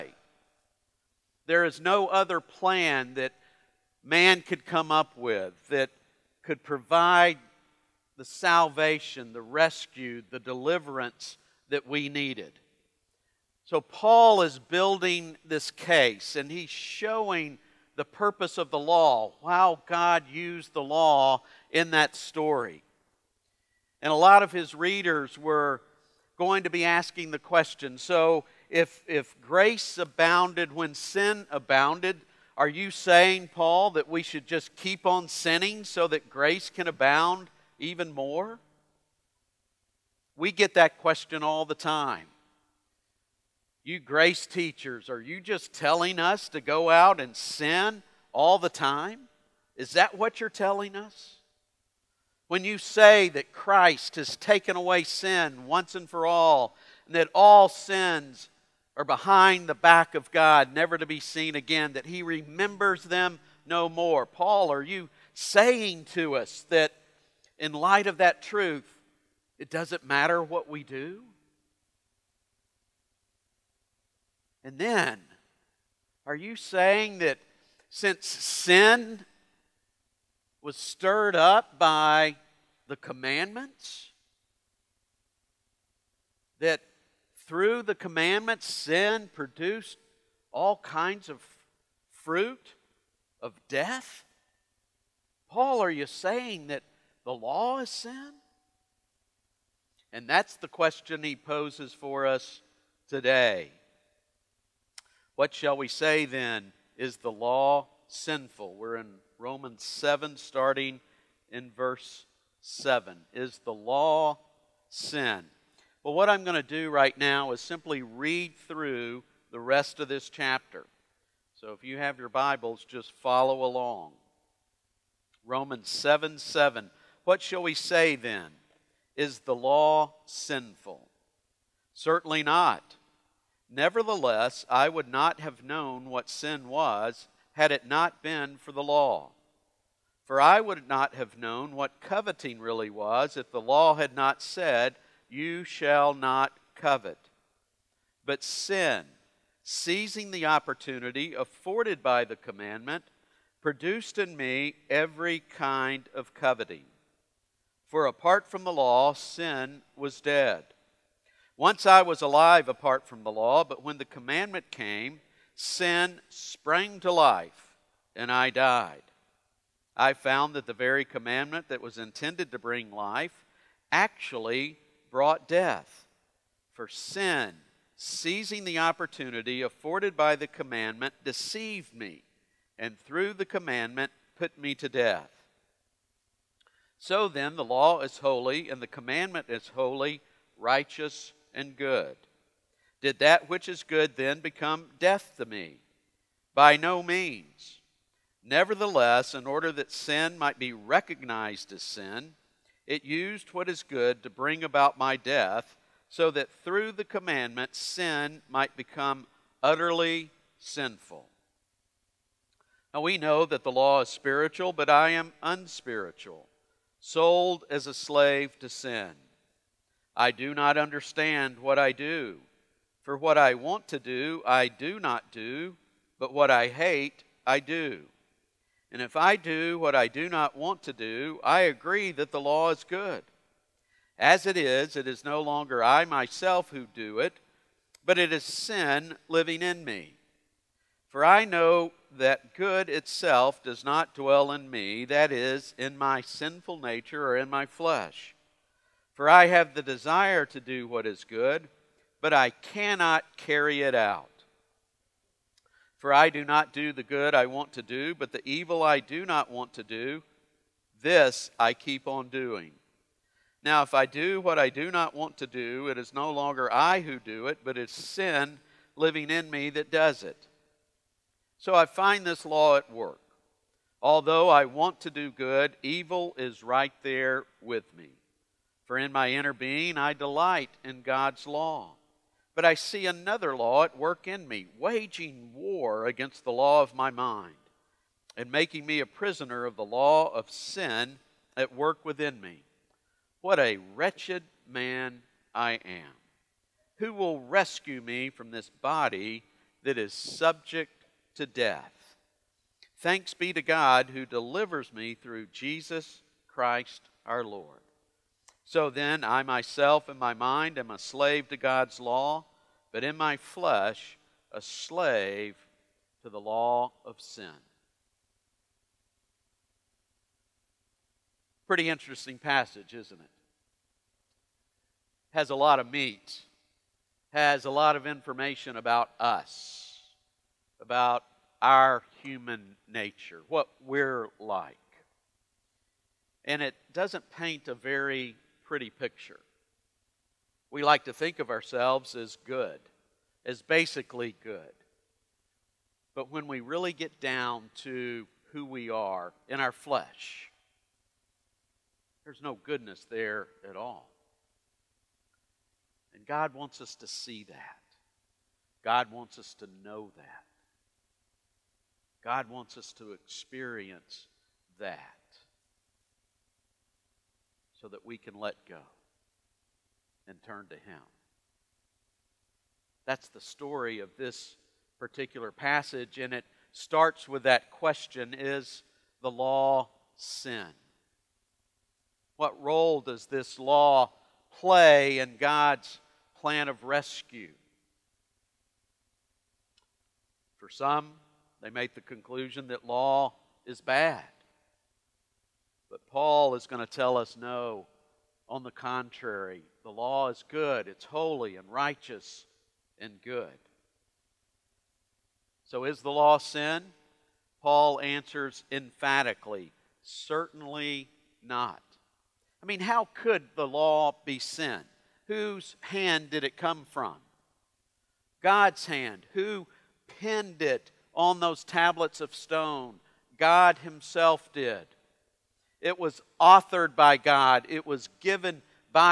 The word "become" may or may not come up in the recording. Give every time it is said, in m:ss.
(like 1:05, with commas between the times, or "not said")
3:14, 3:28.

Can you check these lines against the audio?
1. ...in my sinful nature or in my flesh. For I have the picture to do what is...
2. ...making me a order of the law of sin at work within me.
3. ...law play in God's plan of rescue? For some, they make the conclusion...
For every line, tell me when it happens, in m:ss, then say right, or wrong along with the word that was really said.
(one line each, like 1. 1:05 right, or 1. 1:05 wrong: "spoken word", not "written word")
1. 4:05 wrong: "desire", not "picture"
2. 4:48 wrong: "prisoner", not "order"
3. 6:23 right.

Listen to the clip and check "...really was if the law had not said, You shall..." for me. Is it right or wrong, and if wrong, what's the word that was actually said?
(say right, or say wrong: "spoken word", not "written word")
right.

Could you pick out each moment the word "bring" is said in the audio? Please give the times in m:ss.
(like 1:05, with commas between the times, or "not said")
2:52, 3:24.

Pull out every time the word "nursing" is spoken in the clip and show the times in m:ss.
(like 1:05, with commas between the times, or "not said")
not said.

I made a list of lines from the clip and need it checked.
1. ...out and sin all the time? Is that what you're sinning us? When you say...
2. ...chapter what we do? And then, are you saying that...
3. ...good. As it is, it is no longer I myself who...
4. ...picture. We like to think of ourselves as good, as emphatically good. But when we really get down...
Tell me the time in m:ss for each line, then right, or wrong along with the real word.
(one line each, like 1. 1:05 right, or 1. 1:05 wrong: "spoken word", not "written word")
1. 0:46 wrong: "telling", not "sinning"
2. 1:10 wrong: "matter", not "chapter"
3. 3:52 right
4. 5:38 wrong: "basically", not "emphatically".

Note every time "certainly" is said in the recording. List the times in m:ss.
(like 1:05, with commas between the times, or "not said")
2:11, 6:50.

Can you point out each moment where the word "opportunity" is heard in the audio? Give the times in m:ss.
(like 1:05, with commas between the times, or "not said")
2:30, 2:58.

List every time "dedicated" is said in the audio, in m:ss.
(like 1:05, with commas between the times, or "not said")
not said.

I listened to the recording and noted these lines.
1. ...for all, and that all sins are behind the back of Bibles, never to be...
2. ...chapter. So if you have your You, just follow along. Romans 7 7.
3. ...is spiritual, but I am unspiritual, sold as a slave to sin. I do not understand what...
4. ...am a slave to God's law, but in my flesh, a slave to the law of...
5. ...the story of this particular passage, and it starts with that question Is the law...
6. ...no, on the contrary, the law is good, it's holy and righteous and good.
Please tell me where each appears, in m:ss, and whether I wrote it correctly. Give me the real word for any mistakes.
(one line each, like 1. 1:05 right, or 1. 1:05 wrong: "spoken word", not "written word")
1. 0:56 wrong: "God", not "Bibles"
2. 2:00 wrong: "Bibles", not "You"
3. 3:34 right
4. 5:10 right
5. 6:13 right
6. 6:37 right.